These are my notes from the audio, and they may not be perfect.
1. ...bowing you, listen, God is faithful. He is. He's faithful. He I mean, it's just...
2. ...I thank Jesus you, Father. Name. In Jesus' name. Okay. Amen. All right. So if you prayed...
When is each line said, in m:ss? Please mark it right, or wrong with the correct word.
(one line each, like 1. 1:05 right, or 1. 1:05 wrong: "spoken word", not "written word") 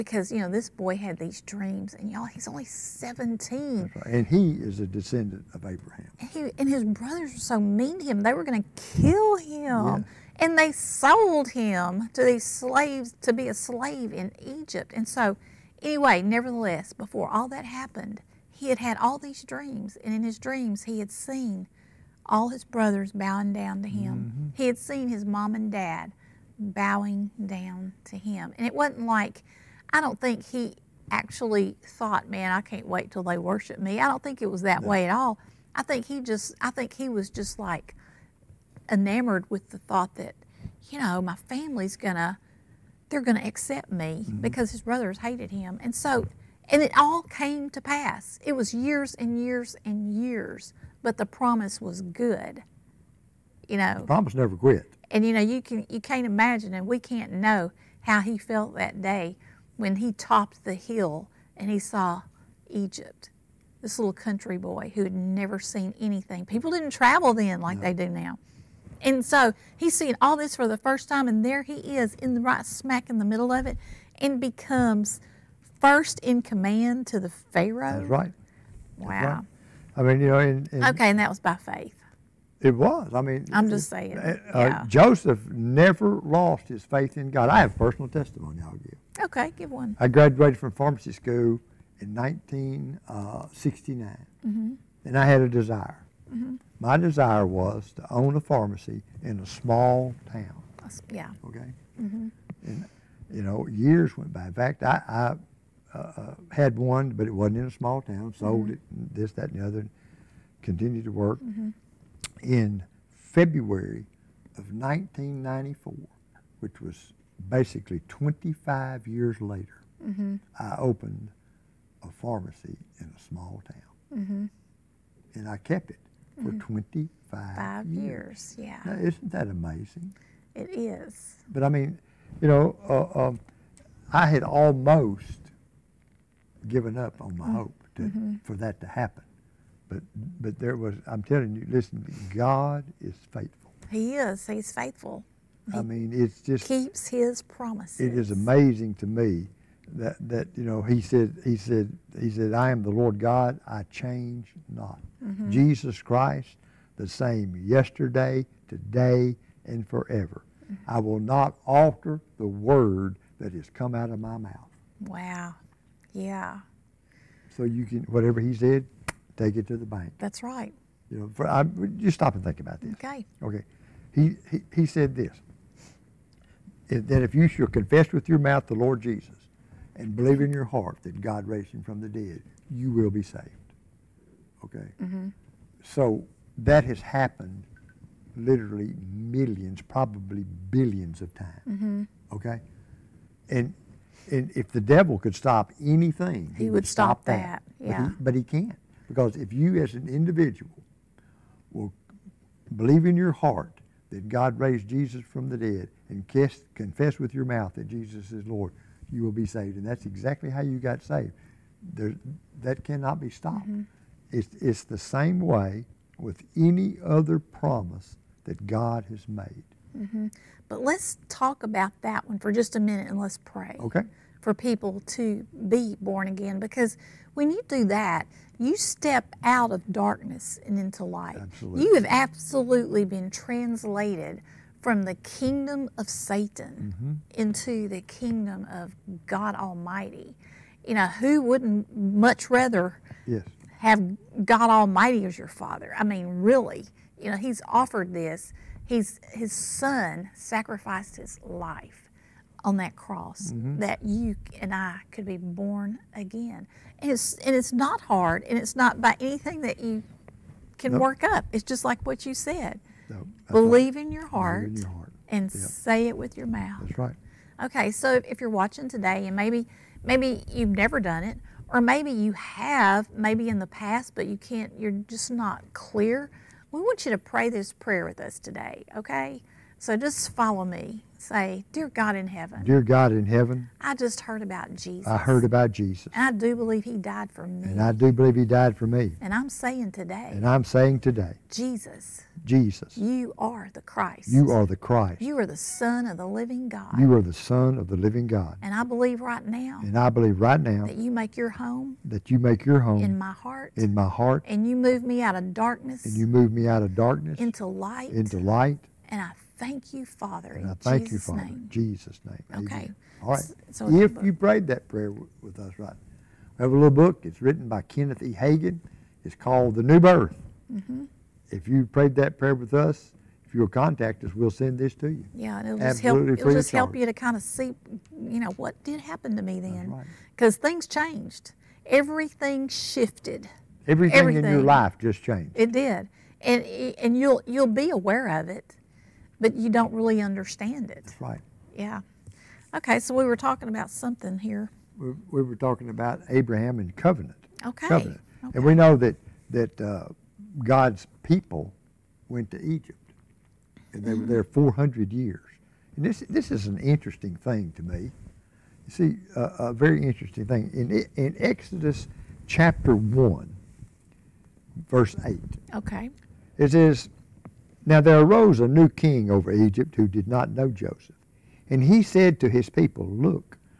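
1. 2:21 wrong: "telling", not "bowing"
2. 5:10 right.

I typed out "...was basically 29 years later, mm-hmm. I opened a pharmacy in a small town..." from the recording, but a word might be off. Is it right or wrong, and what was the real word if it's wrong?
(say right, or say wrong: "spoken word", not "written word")
wrong: "25", not "29".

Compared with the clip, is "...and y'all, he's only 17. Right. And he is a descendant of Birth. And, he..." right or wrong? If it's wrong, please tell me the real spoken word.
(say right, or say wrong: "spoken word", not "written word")
wrong: "Abraham", not "Birth".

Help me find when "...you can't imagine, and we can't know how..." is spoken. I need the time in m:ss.
0:55.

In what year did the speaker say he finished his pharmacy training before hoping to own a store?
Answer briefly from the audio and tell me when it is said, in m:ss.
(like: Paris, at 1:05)
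1969, at 1:32.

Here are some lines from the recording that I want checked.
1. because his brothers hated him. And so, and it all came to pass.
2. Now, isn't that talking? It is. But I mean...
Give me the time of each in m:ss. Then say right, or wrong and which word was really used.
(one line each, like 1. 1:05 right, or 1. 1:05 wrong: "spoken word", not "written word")
1. 0:44 right
2. 2:08 wrong: "amazing", not "talking".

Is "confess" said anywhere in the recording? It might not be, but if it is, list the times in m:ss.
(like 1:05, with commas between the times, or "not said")
2:57, 3:26.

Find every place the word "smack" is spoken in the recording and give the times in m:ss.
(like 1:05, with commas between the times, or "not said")
1:12.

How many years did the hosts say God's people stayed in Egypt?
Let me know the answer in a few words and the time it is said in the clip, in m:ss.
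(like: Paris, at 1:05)
400, at 5:54.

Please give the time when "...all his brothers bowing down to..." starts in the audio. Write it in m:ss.
0:22.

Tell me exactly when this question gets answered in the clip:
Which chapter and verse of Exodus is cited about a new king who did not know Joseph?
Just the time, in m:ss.
6:02.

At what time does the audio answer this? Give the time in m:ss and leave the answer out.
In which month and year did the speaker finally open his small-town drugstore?
1:53.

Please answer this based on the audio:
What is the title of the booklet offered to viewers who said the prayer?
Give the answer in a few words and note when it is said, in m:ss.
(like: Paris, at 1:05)
The New Birth, at 5:19.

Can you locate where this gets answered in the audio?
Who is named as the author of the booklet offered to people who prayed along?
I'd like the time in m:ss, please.
5:17.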